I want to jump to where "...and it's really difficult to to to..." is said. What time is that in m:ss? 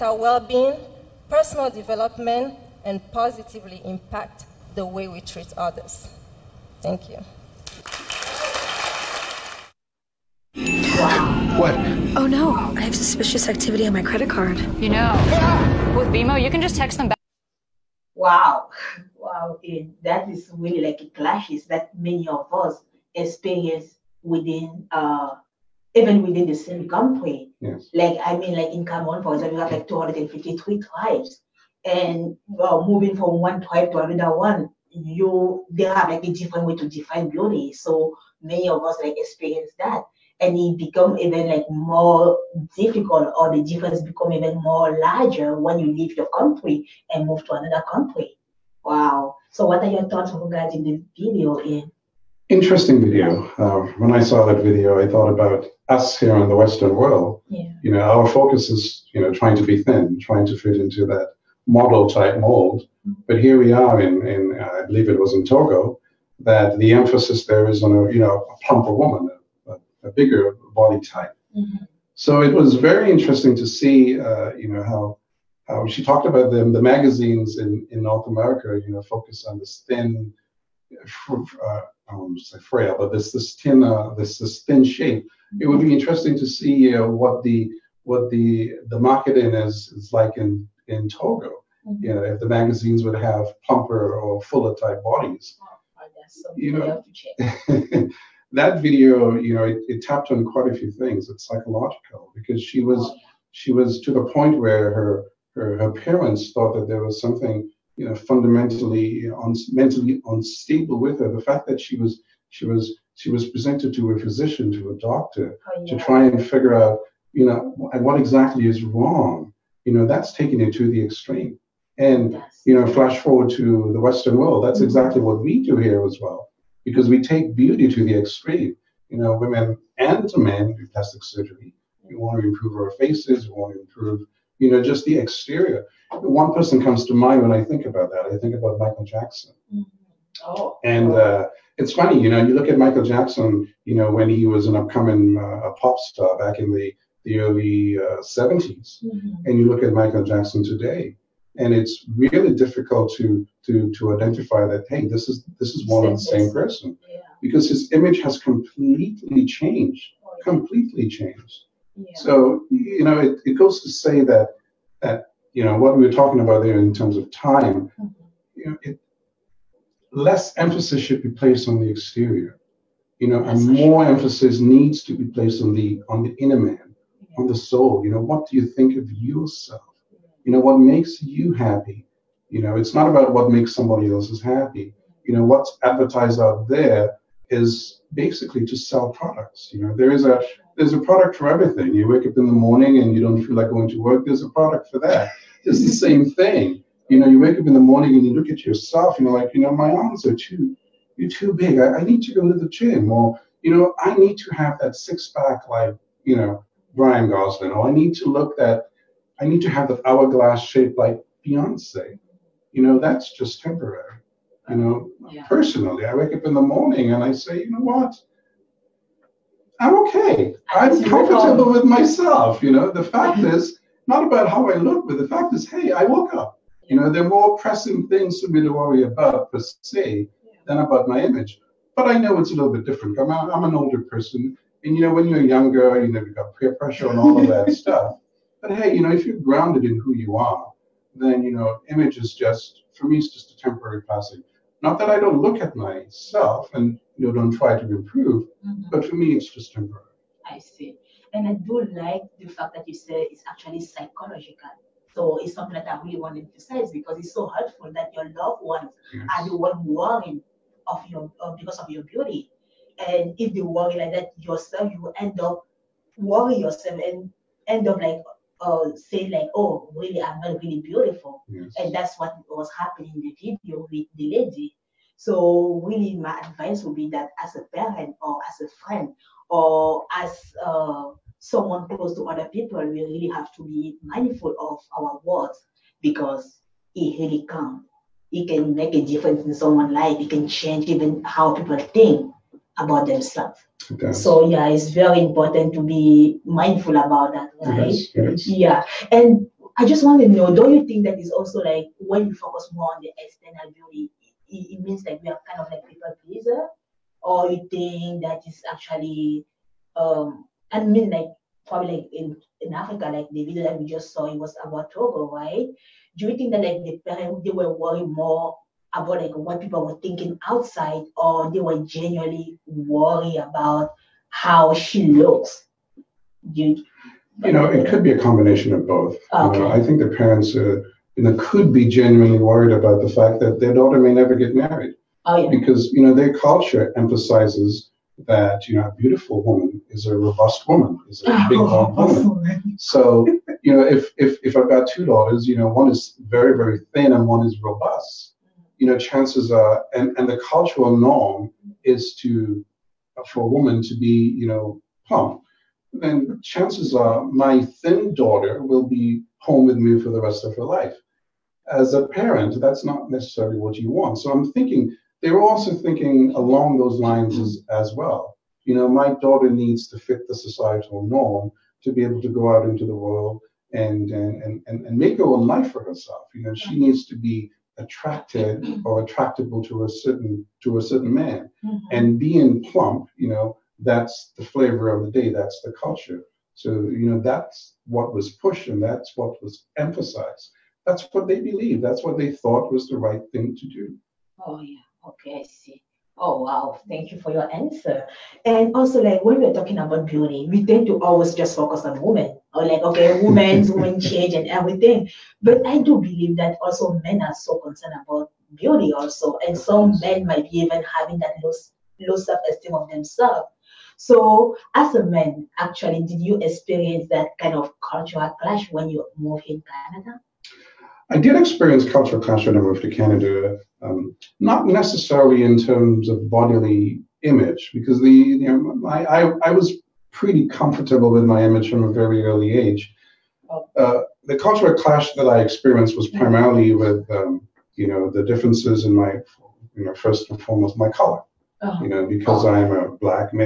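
2:31.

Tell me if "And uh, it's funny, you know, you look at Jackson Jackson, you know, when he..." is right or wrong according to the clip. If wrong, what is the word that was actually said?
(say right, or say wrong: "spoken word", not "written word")
wrong: "Michael", not "Jackson".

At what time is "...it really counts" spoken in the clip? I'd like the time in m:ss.
4:46.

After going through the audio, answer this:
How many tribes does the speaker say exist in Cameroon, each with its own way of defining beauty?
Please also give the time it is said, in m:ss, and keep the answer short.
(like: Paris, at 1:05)
253, at 0:29.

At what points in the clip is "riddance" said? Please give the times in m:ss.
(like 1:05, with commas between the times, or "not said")
not said.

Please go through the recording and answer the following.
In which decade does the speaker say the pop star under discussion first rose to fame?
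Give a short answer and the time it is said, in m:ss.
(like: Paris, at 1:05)
1970s, at 2:28.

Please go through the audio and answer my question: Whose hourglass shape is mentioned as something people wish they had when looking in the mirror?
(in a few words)
Beyonce.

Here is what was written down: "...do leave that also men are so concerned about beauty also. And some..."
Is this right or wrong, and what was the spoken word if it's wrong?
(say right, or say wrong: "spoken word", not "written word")
wrong: "believe", not "leave".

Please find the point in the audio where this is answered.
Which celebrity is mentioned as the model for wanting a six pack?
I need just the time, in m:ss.
3:26.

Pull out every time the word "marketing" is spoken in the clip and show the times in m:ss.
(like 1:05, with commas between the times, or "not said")
1:28.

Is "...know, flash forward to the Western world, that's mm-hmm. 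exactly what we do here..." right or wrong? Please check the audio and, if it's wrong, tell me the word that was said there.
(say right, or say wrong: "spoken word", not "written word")
right.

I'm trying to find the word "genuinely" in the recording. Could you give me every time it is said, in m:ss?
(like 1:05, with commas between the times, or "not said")
5:21, 5:31.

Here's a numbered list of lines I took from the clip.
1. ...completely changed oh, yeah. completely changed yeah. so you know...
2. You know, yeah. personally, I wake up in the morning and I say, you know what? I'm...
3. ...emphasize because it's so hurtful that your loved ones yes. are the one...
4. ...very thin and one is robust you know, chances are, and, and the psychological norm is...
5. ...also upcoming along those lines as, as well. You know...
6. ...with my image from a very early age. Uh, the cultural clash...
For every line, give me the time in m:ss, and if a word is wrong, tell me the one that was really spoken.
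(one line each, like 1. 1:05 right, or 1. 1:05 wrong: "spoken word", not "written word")
1. 2:38 right
2. 3:34 right
3. 4:16 right
4. 5:46 wrong: "cultural", not "psychological"
5. 6:05 wrong: "thinking", not "upcoming"
6. 7:11 right.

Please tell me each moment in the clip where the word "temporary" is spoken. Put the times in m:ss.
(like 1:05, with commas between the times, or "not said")
3:33, 4:03, 4:09.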